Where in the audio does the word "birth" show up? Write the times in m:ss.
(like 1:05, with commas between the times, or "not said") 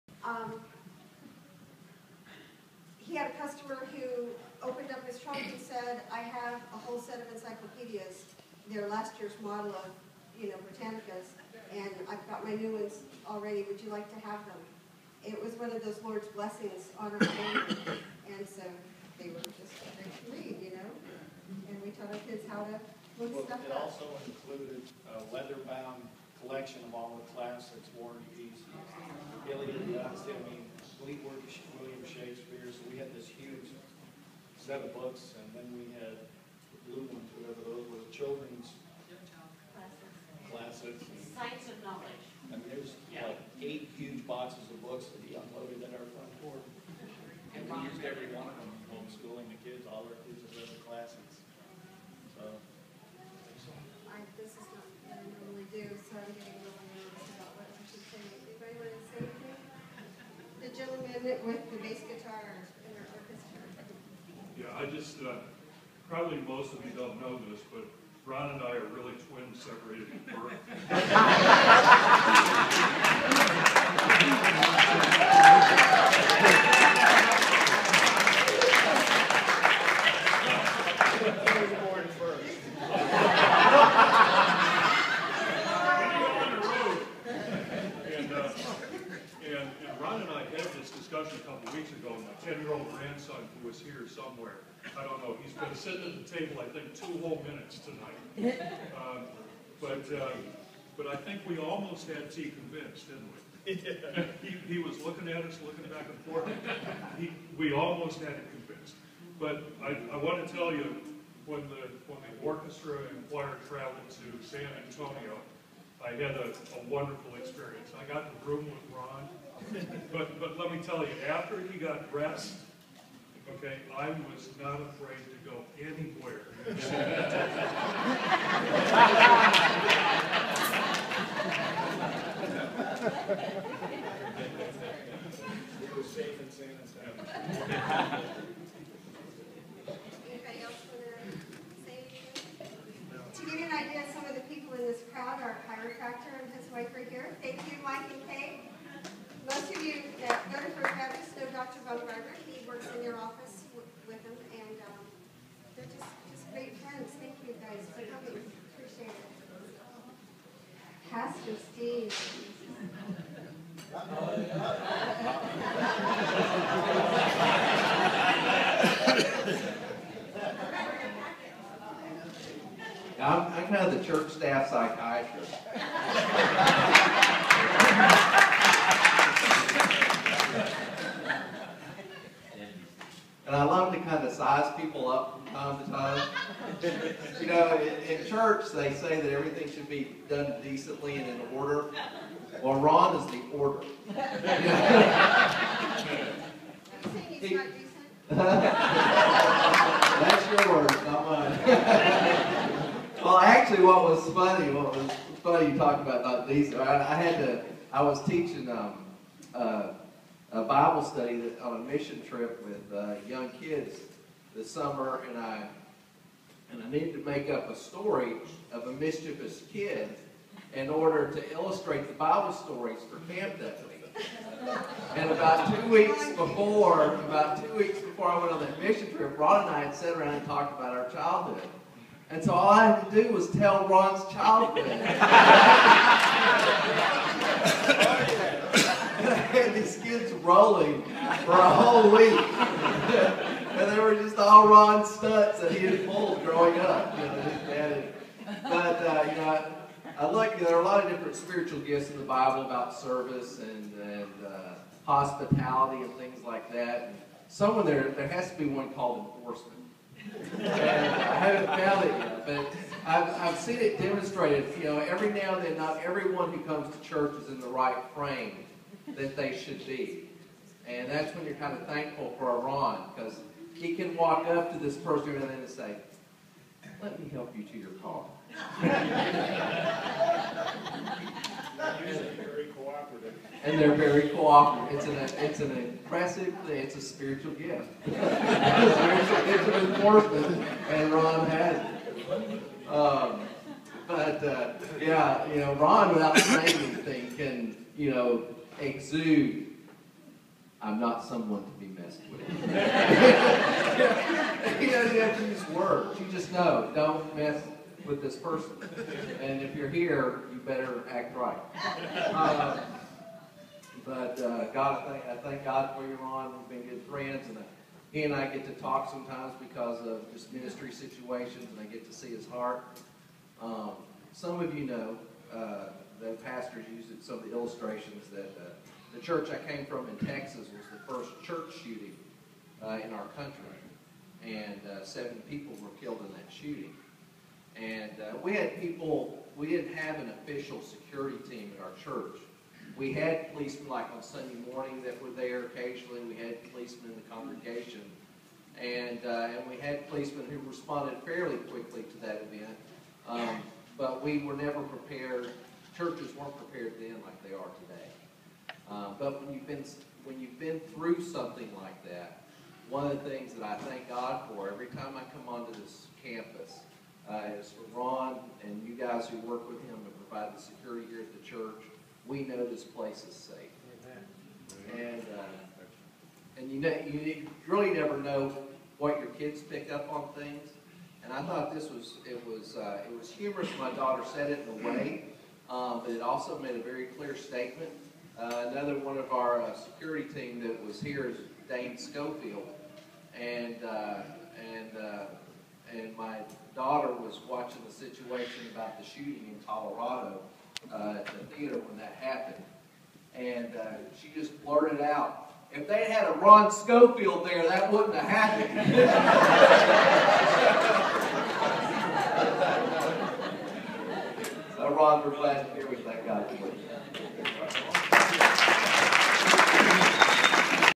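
1:13.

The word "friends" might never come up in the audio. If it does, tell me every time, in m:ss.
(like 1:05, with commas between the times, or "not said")
2:36, 5:17.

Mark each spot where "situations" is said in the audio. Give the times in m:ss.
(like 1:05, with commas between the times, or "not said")
5:20, 6:37.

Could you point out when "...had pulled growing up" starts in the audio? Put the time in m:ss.
4:05.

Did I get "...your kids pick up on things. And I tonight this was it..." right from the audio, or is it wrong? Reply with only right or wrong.
wrong.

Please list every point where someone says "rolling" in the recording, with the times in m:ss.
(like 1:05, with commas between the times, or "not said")
4:00.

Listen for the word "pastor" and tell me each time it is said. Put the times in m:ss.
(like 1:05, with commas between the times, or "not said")
2:41, 5:26.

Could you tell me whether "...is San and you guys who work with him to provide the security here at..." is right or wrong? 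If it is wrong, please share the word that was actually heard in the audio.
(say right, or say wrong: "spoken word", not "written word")
wrong: "Ron", not "San".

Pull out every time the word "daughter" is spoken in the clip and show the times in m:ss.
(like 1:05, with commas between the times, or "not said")
6:23, 6:36.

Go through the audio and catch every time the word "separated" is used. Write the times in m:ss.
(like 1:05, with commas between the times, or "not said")
1:09.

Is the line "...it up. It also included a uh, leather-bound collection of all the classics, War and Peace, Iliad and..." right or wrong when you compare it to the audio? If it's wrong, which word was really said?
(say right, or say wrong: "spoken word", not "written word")
right.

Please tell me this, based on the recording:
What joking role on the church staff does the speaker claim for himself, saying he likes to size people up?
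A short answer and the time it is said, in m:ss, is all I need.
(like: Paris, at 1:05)
Church staff psychiatrist, at 2:54.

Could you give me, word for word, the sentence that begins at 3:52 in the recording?
And so all I had to do was tell Ron's childhood.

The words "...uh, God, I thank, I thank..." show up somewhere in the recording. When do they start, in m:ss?
5:14.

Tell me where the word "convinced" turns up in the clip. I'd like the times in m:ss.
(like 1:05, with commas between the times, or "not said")
1:42, 1:48.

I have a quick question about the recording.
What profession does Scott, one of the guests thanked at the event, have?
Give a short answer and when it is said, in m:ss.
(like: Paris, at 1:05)
Chiropractor, at 2:25.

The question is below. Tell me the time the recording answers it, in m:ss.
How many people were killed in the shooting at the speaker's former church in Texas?
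5:35.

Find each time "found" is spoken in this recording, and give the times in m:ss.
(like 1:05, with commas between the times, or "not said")
4:21.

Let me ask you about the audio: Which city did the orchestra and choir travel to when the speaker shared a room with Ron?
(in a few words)
San Antonio.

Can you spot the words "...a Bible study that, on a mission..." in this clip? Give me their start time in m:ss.
3:30.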